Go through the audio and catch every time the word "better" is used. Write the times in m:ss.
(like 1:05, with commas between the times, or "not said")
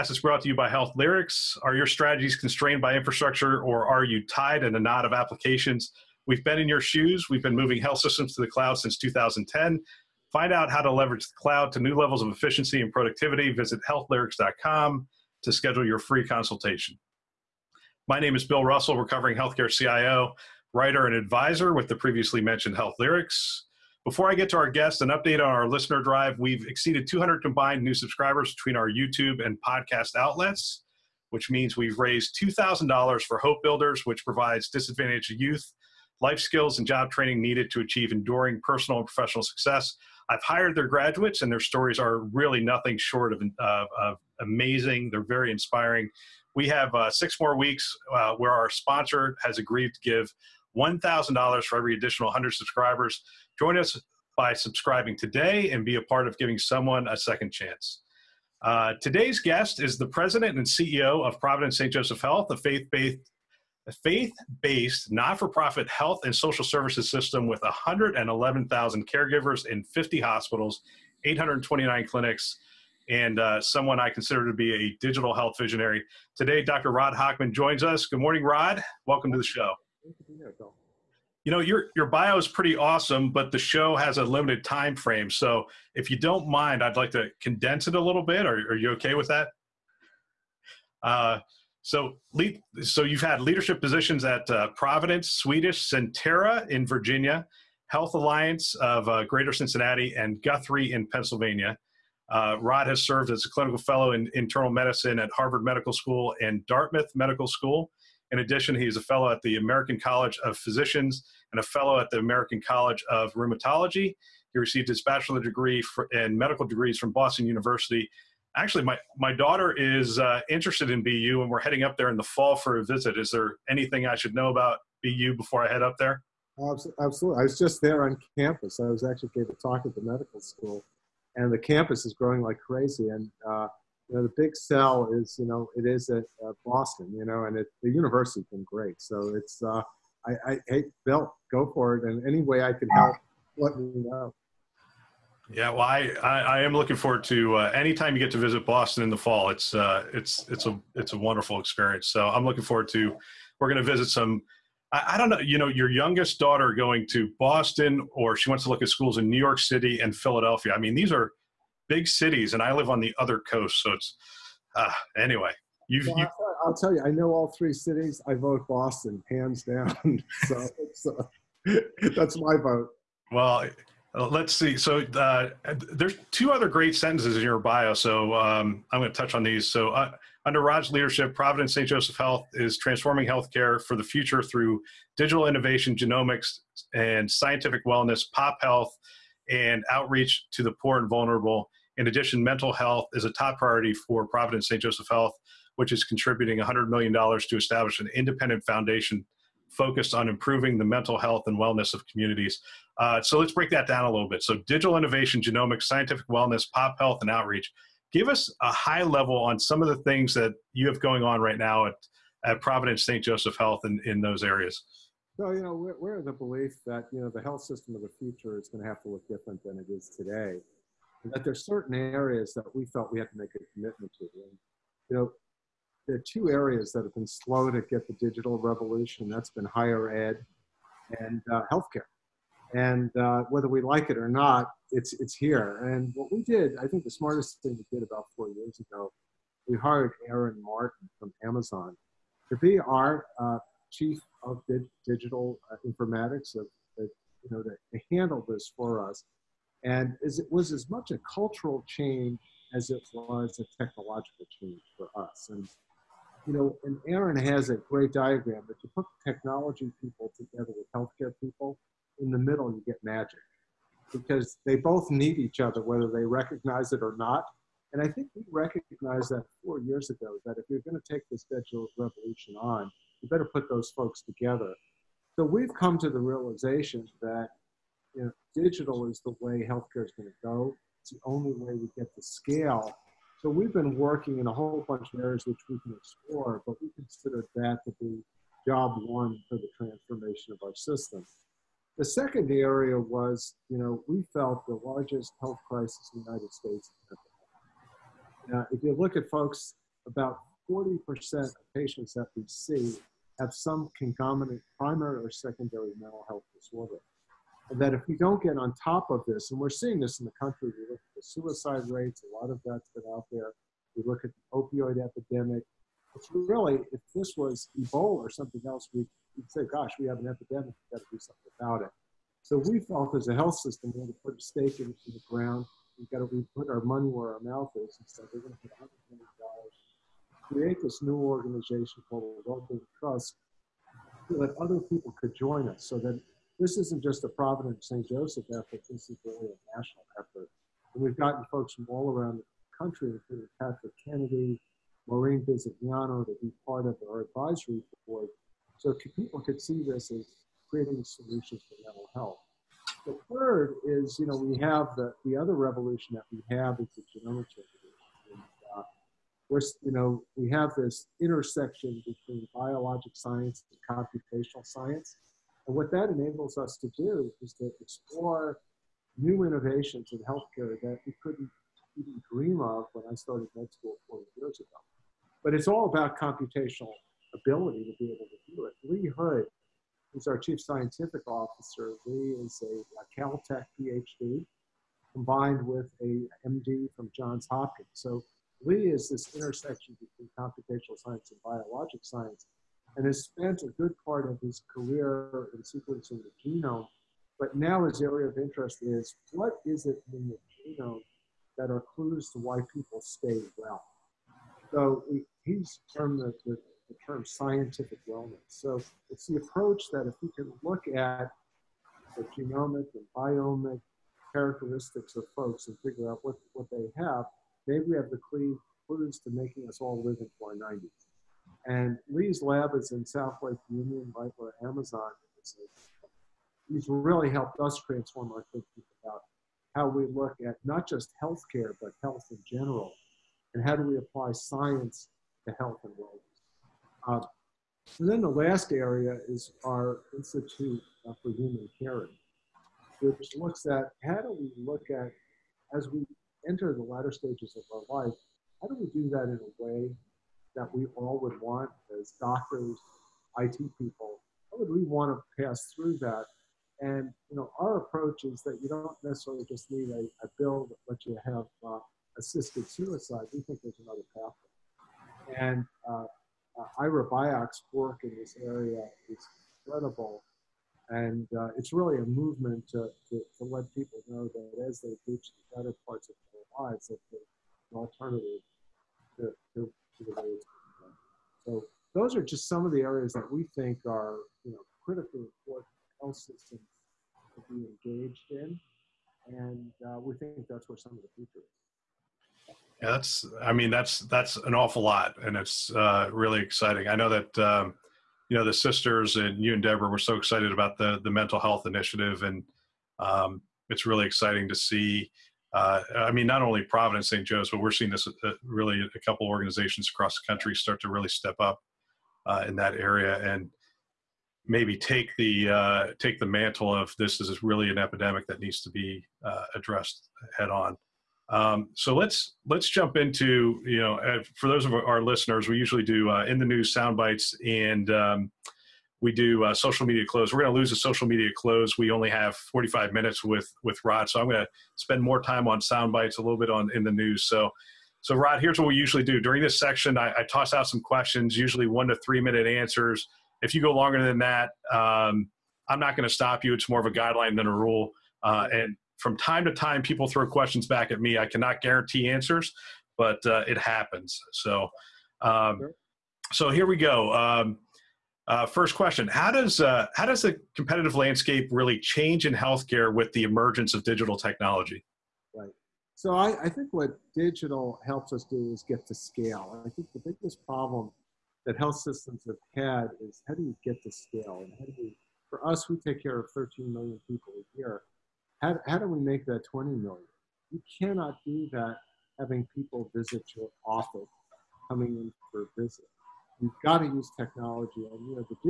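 4:33, 7:55.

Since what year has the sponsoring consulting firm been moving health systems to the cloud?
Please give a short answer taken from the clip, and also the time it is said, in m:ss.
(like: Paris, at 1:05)
2010, at 0:08.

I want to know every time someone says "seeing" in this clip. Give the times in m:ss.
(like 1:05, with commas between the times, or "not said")
5:09, 8:27.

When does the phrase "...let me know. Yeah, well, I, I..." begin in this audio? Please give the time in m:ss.
2:23.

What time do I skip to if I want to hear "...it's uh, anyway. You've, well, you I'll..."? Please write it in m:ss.
2:43.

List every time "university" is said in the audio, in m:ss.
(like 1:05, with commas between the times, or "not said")
1:57, 2:17.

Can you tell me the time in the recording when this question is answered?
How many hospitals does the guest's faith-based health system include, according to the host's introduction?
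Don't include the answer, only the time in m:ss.
1:09.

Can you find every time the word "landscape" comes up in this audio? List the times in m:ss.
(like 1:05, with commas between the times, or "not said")
9:20.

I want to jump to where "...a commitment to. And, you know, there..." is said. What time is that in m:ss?
3:43.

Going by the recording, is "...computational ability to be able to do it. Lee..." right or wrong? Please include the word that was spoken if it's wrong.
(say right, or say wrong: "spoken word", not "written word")
right.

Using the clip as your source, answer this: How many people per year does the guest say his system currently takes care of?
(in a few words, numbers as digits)
13 million.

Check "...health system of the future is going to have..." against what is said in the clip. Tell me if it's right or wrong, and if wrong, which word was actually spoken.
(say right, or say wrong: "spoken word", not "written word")
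right.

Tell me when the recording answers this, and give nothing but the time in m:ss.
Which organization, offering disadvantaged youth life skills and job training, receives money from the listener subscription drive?
0:33.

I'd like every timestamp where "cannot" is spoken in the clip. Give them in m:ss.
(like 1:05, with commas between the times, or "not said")
9:11, 9:40.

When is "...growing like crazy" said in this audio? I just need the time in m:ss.
2:12.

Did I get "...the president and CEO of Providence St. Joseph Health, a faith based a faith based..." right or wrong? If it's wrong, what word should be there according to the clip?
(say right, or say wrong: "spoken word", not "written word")
right.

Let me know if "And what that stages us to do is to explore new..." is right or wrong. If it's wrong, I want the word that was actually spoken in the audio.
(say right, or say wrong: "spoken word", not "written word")
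wrong: "enables", not "stages".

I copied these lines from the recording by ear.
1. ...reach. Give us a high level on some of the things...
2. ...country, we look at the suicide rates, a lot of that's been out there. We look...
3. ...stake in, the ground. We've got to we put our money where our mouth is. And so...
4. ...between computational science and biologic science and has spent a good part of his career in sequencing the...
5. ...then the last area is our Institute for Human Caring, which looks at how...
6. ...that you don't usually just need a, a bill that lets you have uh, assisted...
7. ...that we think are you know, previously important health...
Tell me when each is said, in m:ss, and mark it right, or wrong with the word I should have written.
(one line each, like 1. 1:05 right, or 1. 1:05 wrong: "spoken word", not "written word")
1. 3:27 wrong: "outreach", not "reach"
2. 5:10 right
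3. 5:24 right
4. 6:30 right
5. 7:18 right
6. 7:38 wrong: "necessarily", not "usually"
7. 8:03 wrong: "critically", not "previously".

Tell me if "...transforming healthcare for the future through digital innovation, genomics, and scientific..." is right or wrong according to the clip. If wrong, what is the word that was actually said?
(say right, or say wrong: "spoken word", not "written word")
right.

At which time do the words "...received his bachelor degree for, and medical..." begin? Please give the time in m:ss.
1:54.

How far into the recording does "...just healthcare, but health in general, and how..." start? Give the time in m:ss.
7:10.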